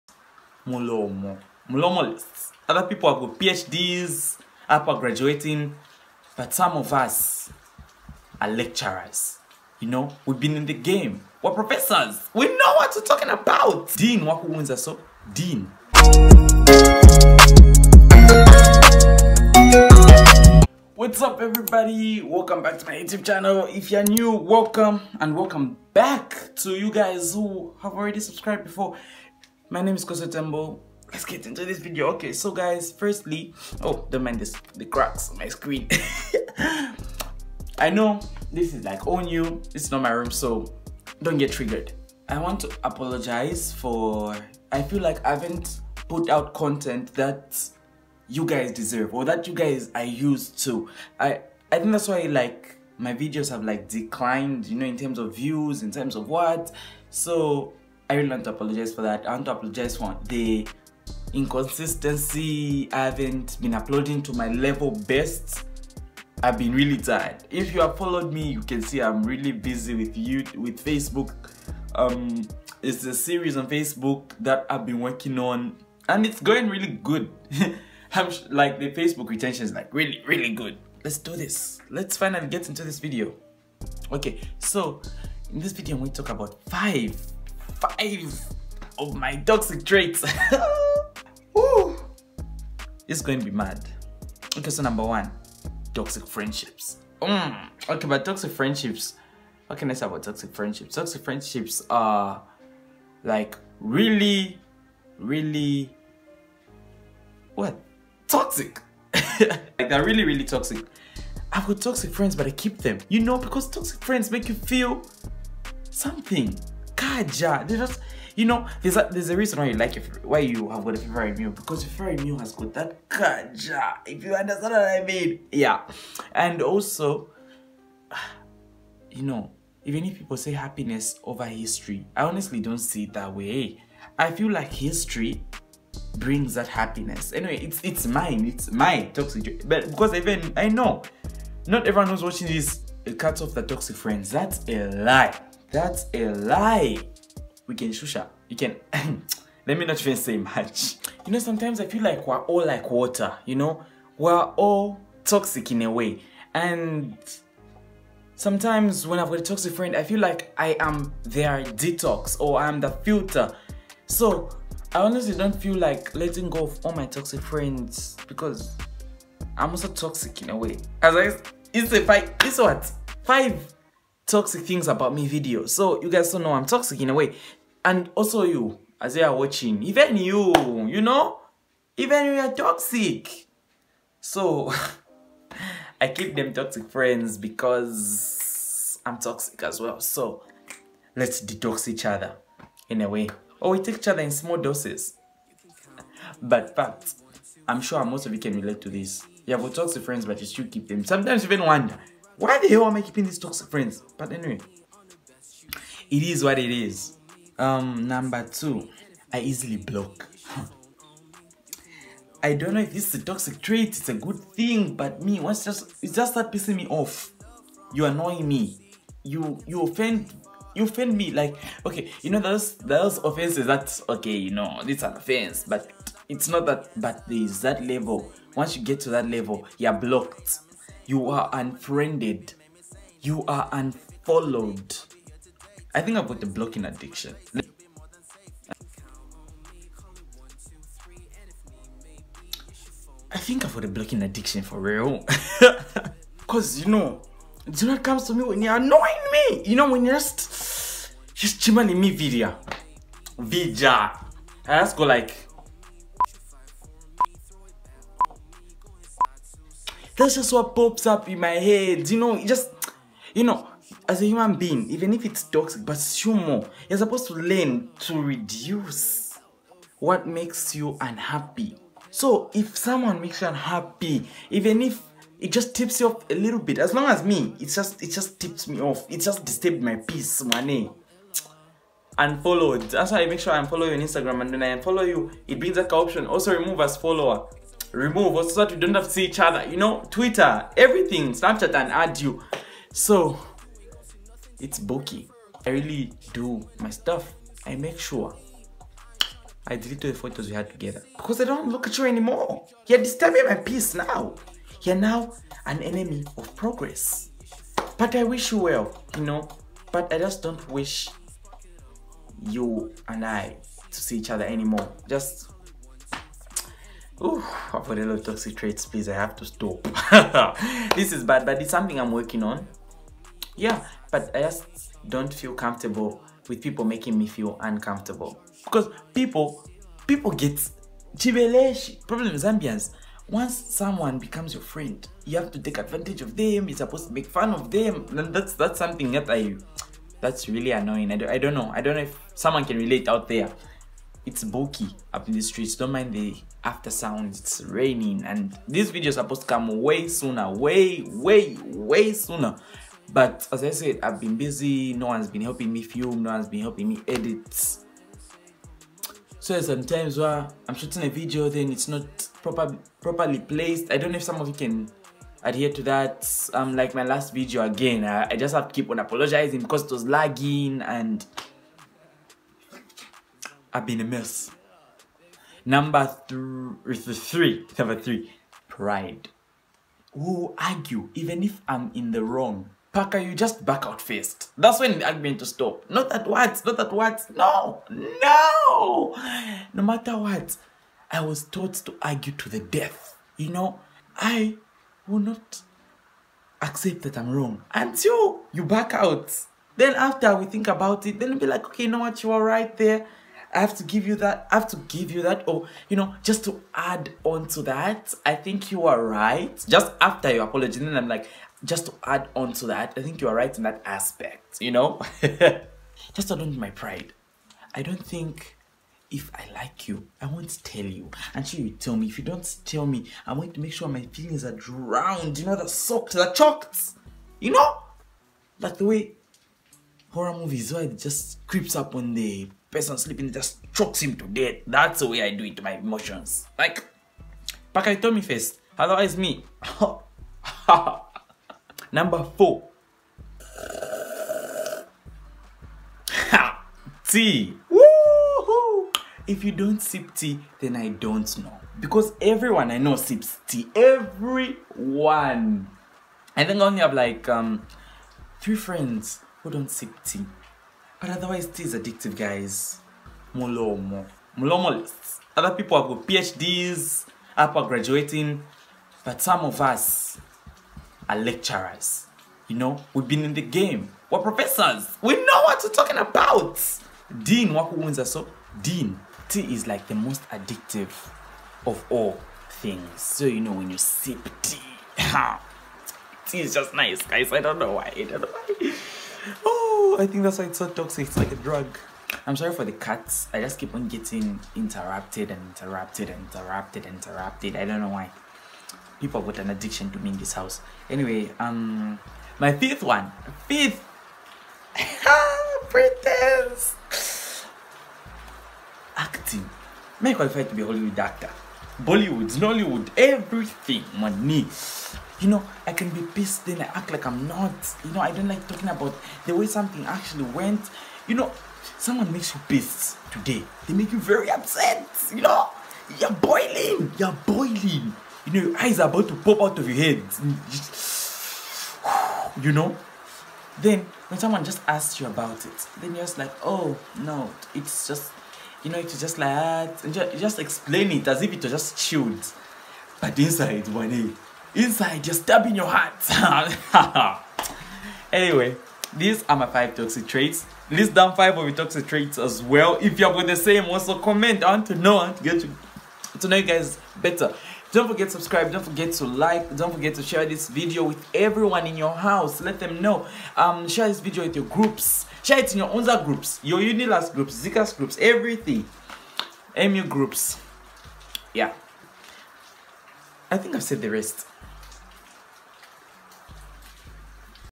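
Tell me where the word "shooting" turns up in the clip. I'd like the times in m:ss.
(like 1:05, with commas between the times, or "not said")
6:00.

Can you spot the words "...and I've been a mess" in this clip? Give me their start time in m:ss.
6:10.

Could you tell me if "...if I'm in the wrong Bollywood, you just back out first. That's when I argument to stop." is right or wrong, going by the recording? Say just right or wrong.
wrong.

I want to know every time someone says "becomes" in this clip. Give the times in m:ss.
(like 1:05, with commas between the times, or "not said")
5:34.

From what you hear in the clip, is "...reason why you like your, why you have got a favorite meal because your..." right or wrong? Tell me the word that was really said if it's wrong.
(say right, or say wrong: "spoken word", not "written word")
right.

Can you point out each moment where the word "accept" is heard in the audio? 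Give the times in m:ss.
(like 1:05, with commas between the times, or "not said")
6:36.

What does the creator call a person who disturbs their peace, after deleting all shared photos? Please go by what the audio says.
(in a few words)
enemy of progress.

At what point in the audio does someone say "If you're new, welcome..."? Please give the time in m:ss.
0:23.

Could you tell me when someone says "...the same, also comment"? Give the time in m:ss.
9:13.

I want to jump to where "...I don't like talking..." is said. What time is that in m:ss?
8:38.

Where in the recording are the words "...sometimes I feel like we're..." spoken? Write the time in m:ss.
2:31.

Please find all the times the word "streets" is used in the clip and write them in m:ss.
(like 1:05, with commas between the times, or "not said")
5:45.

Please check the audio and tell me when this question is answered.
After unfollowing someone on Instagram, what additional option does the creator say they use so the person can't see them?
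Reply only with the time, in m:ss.
4:46.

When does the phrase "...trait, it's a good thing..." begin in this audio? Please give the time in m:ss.
3:33.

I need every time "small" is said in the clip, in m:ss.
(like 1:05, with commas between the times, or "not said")
3:14.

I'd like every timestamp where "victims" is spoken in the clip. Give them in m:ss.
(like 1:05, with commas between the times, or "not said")
not said.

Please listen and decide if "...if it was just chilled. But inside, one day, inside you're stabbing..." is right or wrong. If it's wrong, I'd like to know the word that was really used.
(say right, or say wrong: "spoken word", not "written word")
right.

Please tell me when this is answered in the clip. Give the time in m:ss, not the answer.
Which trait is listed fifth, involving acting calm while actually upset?
8:25.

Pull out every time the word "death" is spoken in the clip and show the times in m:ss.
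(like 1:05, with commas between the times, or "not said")
6:32, 7:14.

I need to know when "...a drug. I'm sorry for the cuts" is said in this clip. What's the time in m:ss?
8:11.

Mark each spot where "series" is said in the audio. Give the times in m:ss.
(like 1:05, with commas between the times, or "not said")
1:13.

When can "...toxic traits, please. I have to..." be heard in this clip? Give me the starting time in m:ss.
5:18.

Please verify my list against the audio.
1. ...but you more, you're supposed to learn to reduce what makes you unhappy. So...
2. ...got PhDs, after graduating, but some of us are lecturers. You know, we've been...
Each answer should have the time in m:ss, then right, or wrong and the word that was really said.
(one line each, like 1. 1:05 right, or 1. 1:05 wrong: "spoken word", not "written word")
1. 4:25 right
2. 7:45 right.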